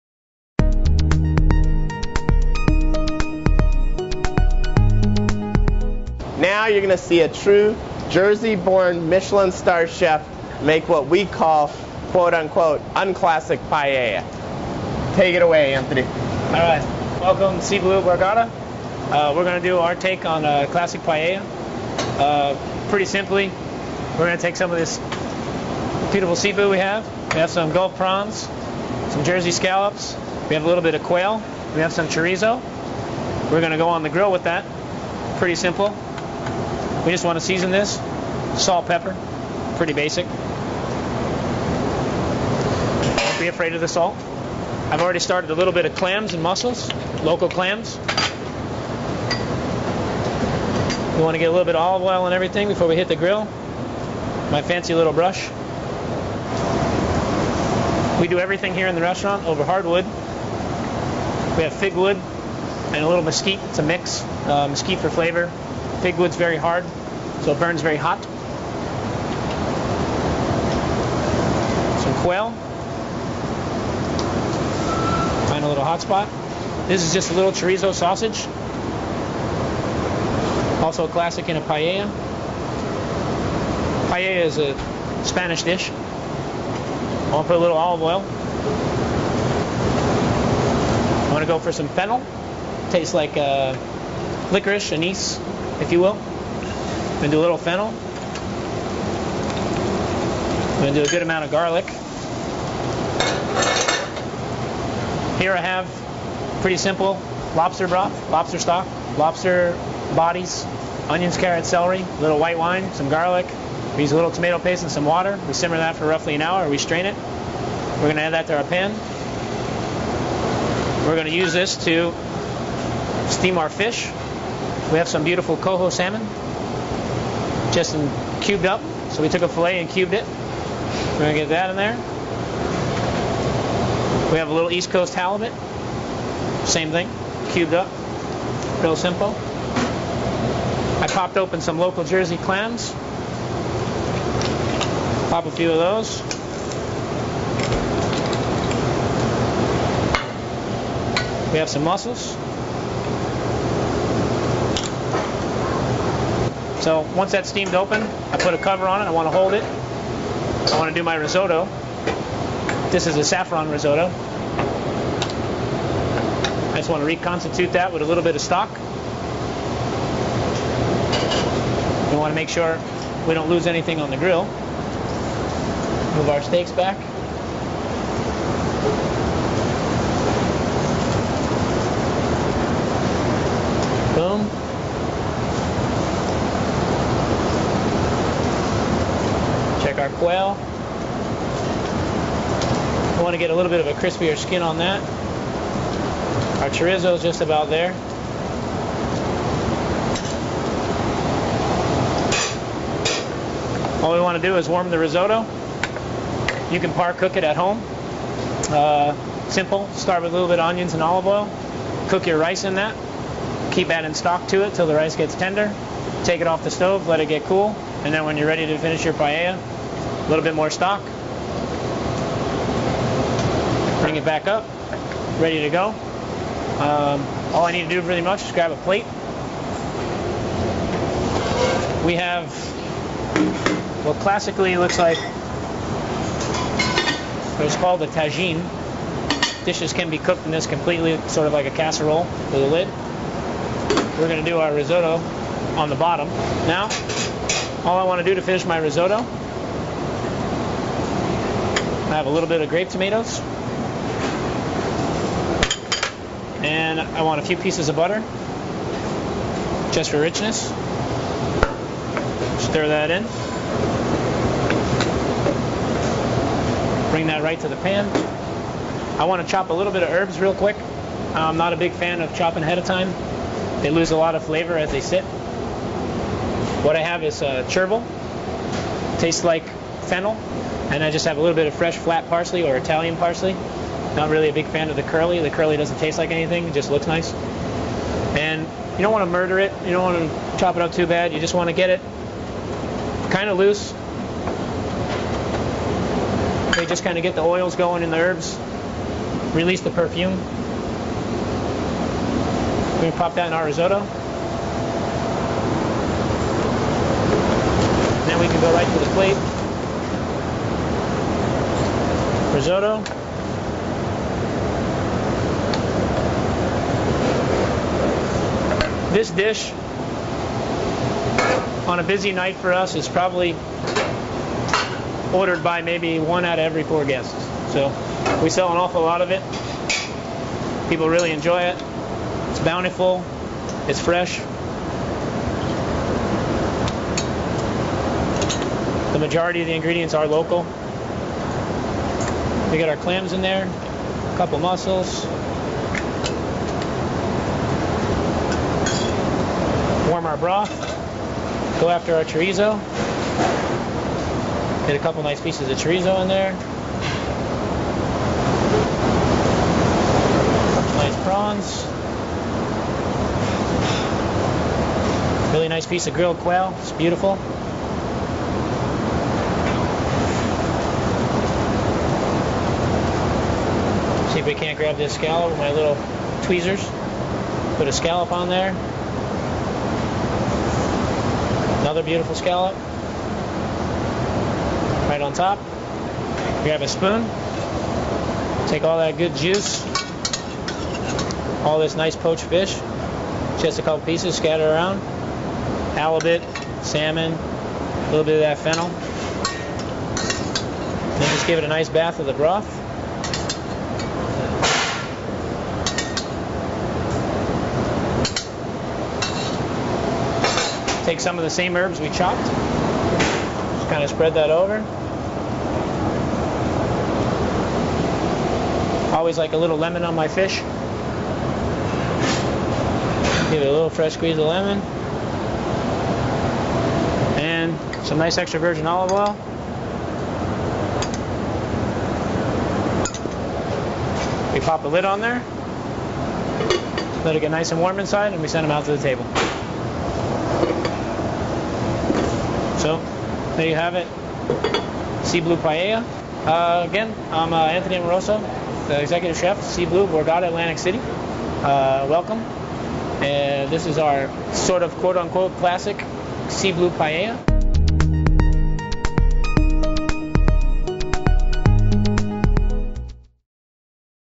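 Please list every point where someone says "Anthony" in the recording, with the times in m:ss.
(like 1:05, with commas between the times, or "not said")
0:15, 7:27.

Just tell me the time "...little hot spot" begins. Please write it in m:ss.
1:15.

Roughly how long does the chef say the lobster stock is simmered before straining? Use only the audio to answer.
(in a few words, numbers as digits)
an hour.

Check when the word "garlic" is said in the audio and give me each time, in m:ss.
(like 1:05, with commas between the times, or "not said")
1:41, 1:53.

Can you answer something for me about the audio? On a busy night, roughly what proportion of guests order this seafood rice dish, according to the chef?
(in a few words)
1 out of every 4.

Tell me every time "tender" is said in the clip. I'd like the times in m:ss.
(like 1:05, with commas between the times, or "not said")
3:35.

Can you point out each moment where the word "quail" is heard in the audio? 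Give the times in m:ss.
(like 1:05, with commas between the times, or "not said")
0:31, 1:12, 3:10, 6:06.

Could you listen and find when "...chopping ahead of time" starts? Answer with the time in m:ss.
4:32.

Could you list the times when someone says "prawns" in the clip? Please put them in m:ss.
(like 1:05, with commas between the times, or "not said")
0:27, 6:01.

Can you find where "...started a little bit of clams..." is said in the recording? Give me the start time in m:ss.
0:45.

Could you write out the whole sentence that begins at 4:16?
And I want a few pieces of butter, just for richness.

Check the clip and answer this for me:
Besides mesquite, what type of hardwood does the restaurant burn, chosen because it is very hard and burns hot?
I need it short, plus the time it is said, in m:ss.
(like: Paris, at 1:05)
fig wood, at 1:01.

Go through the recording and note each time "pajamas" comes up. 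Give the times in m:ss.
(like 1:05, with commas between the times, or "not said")
not said.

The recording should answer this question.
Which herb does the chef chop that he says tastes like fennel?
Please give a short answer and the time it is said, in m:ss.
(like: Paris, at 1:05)
chervil, at 4:37.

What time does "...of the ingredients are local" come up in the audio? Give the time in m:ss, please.
5:39.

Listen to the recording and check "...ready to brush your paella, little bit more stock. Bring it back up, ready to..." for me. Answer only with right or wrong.
wrong.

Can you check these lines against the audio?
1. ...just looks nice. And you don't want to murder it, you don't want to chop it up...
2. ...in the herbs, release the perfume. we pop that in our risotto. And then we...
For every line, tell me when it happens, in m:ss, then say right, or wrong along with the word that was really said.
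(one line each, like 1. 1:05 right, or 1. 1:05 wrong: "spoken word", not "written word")
1. 4:46 right
2. 4:58 right.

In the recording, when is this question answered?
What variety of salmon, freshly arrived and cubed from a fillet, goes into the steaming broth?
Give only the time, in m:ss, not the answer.
2:05.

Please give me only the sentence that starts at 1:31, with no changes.
I'm gonna go for some fennel.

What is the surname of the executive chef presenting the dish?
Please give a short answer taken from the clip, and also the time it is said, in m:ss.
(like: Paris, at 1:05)
Amoroso, at 7:27.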